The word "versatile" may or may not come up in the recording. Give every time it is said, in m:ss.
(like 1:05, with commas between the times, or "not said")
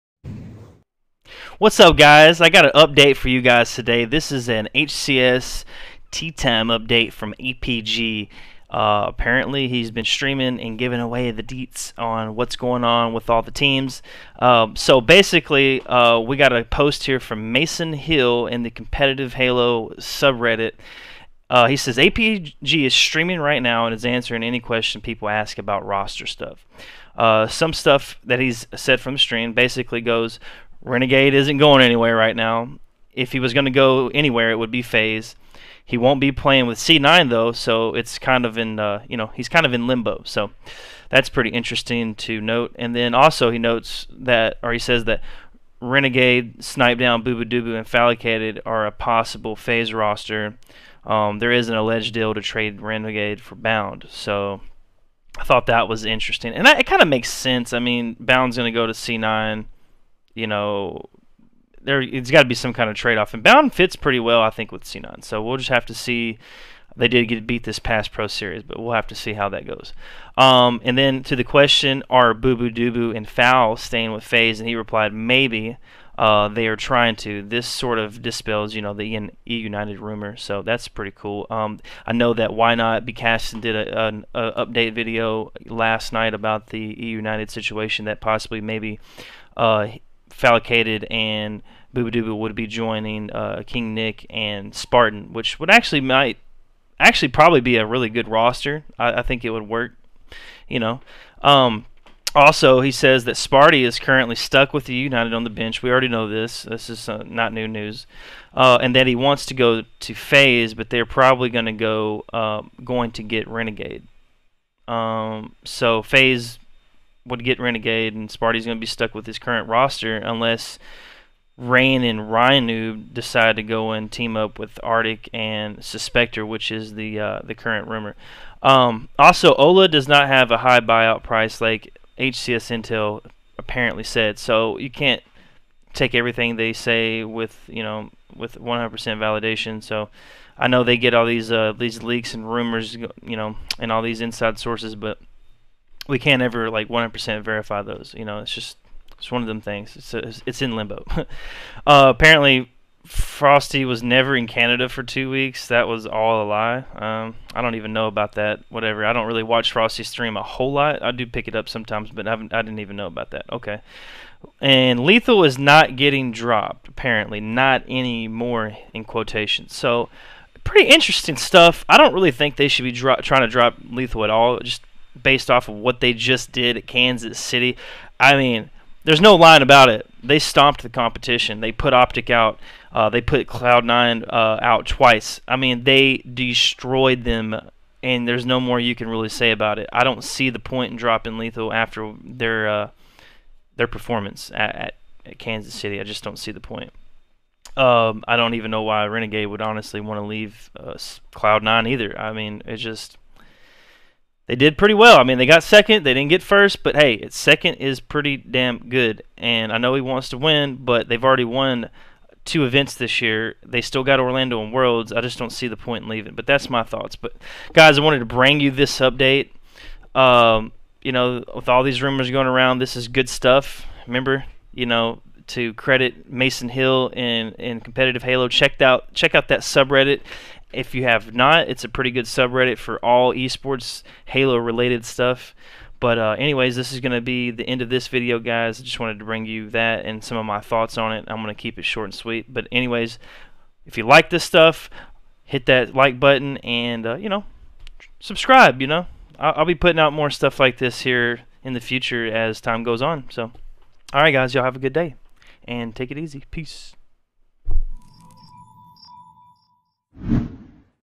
not said.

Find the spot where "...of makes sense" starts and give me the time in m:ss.
0:57.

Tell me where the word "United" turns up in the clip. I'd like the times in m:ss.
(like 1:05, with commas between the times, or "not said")
1:19, 1:27, 1:44.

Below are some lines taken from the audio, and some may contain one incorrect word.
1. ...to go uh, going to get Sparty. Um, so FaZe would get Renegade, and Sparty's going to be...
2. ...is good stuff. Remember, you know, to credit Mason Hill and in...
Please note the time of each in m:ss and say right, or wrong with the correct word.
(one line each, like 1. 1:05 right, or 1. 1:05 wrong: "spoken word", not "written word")
1. 1:51 wrong: "Renegade", not "Sparty"
2. 3:42 right.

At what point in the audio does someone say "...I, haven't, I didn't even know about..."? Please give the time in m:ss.
2:42.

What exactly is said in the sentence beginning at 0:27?
Uh, some stuff that he's said from the stream basically goes Renegade isn't going anywhere right now.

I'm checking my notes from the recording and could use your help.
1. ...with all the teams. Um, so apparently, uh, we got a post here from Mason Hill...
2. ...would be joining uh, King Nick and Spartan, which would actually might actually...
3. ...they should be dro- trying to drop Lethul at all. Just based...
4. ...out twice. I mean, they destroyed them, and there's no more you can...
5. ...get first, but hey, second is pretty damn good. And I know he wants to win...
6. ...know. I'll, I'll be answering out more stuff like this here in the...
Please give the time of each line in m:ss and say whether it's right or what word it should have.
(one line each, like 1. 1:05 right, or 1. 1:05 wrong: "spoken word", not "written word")
1. 0:13 wrong: "basically", not "apparently"
2. 1:32 right
3. 2:52 right
4. 3:04 right
5. 3:26 right
6. 4:08 wrong: "putting", not "answering".